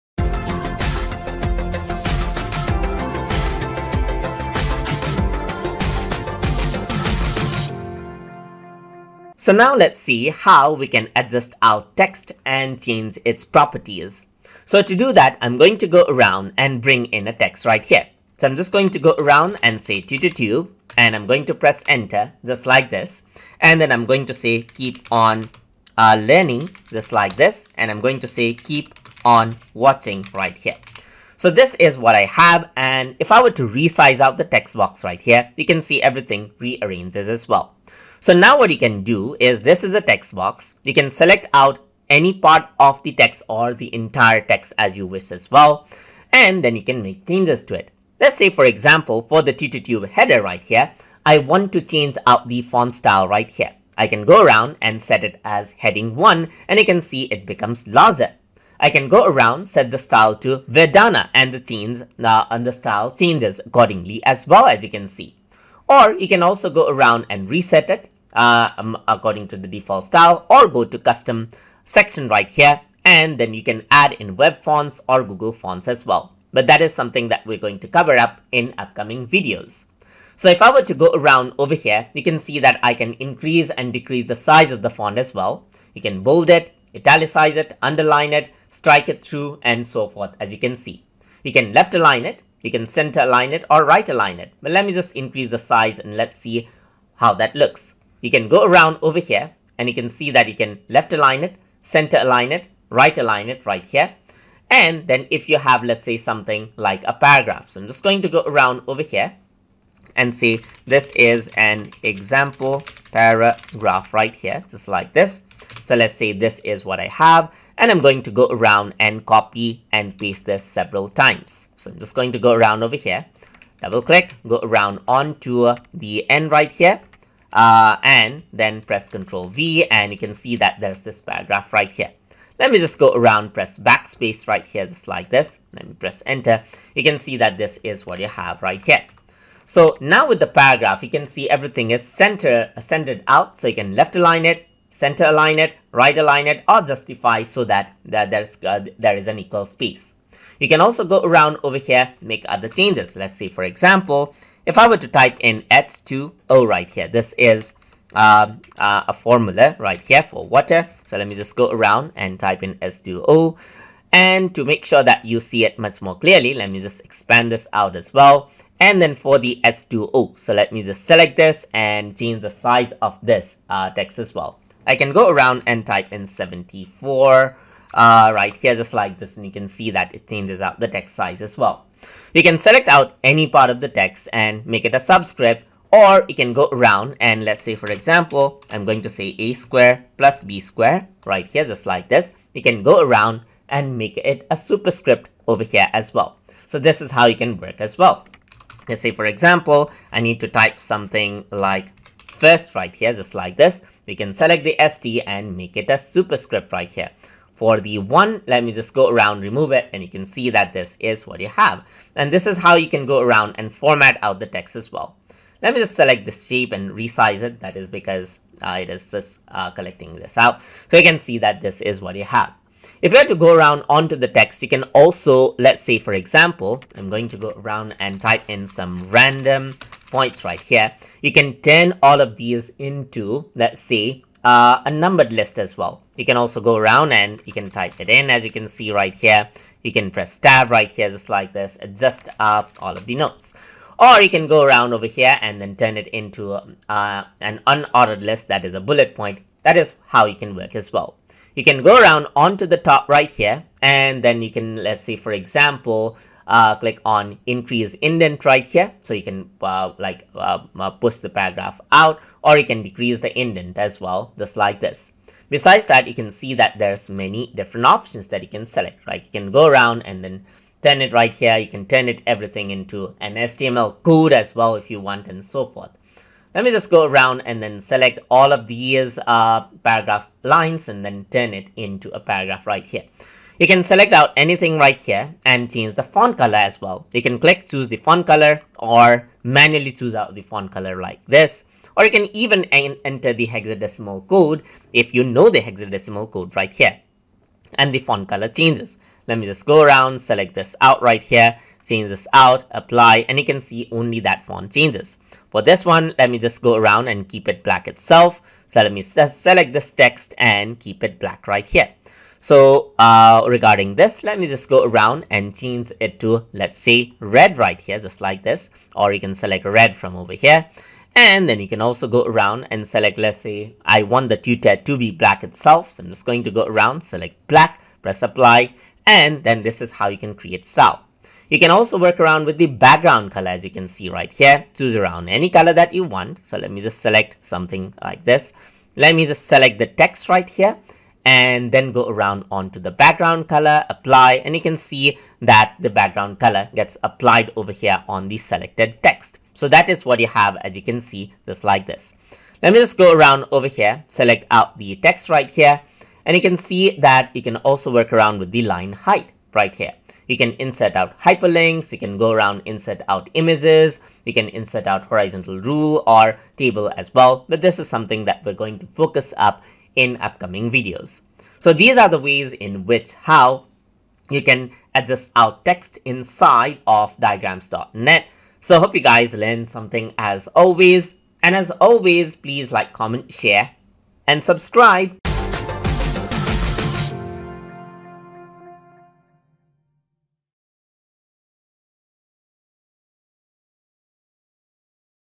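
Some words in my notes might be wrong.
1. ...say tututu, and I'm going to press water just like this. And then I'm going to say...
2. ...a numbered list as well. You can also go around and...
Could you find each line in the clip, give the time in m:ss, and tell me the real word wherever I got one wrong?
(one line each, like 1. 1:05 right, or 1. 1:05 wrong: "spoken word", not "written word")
1. 0:19 wrong: "enter", not "water"
2. 3:54 right.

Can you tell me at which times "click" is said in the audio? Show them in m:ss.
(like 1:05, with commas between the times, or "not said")
2:04, 4:16, 4:47.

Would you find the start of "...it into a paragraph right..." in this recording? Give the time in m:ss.
4:41.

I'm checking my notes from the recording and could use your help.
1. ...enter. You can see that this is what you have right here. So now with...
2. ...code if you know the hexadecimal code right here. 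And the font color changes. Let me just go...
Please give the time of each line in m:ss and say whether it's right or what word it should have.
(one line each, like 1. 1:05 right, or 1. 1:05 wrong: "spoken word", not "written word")
1. 2:16 right
2. 4:54 right.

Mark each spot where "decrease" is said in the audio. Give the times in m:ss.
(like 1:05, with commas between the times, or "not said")
1:23, 4:22.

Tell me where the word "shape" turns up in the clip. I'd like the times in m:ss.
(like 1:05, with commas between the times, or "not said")
3:36.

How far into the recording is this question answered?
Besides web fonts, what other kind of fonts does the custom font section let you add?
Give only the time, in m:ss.
1:15.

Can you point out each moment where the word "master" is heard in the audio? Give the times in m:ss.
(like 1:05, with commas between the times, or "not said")
not said.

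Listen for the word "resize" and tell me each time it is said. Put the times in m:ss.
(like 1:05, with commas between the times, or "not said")
0:33, 3:36.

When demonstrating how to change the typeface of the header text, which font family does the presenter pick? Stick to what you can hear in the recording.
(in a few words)
Verdana.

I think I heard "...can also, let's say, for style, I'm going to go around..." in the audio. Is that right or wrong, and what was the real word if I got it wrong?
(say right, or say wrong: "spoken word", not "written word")
wrong: "example", not "style".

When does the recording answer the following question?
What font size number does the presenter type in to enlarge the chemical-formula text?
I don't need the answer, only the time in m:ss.
2:56.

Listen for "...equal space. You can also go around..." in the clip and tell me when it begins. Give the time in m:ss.
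2:29.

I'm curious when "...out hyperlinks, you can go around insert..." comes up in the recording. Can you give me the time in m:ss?
6:00.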